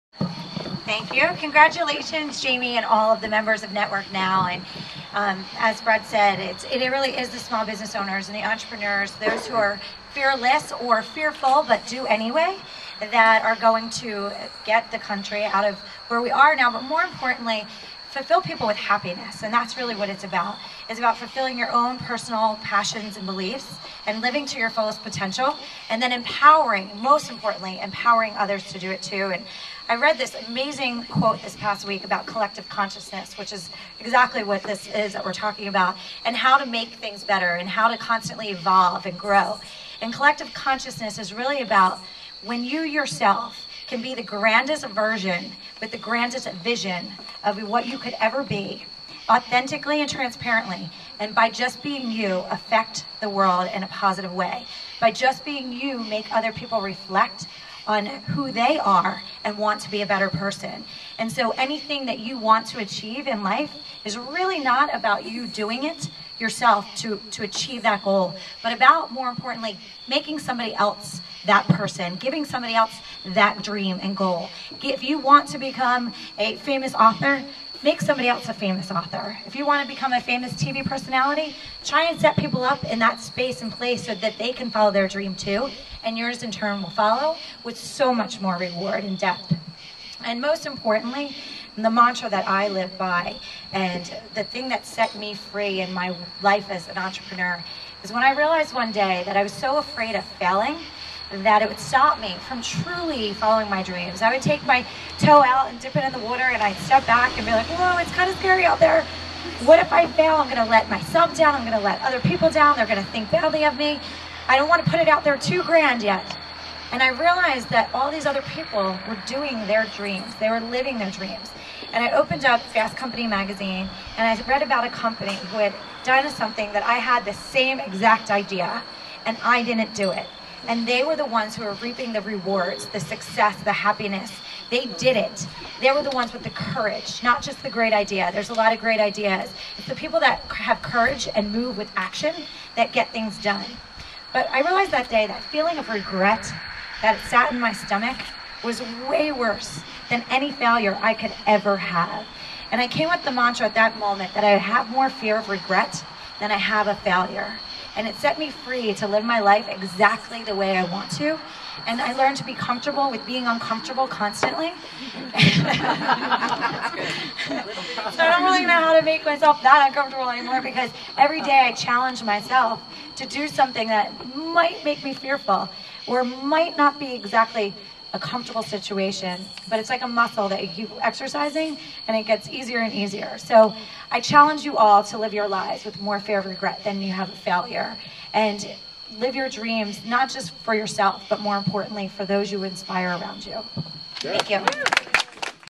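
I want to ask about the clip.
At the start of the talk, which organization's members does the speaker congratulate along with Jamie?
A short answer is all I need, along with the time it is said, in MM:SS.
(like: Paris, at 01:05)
Network Now, at 00:03.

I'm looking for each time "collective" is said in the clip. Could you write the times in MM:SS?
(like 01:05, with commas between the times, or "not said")
00:32, 00:40.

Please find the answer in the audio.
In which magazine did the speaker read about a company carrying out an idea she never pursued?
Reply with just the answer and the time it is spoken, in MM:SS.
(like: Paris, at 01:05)
Fast Company, at 02:02.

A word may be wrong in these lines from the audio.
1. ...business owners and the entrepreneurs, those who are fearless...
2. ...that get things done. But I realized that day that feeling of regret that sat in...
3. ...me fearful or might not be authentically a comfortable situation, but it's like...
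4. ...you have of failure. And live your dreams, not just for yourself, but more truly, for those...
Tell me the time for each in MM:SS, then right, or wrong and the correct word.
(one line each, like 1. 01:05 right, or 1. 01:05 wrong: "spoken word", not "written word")
1. 00:07 right
2. 02:22 right
3. 02:55 wrong: "exactly", not "authentically"
4. 03:07 wrong: "importantly", not "truly".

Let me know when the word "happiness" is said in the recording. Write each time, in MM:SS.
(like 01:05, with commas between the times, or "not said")
00:18, 02:13.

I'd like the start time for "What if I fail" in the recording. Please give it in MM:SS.
01:49.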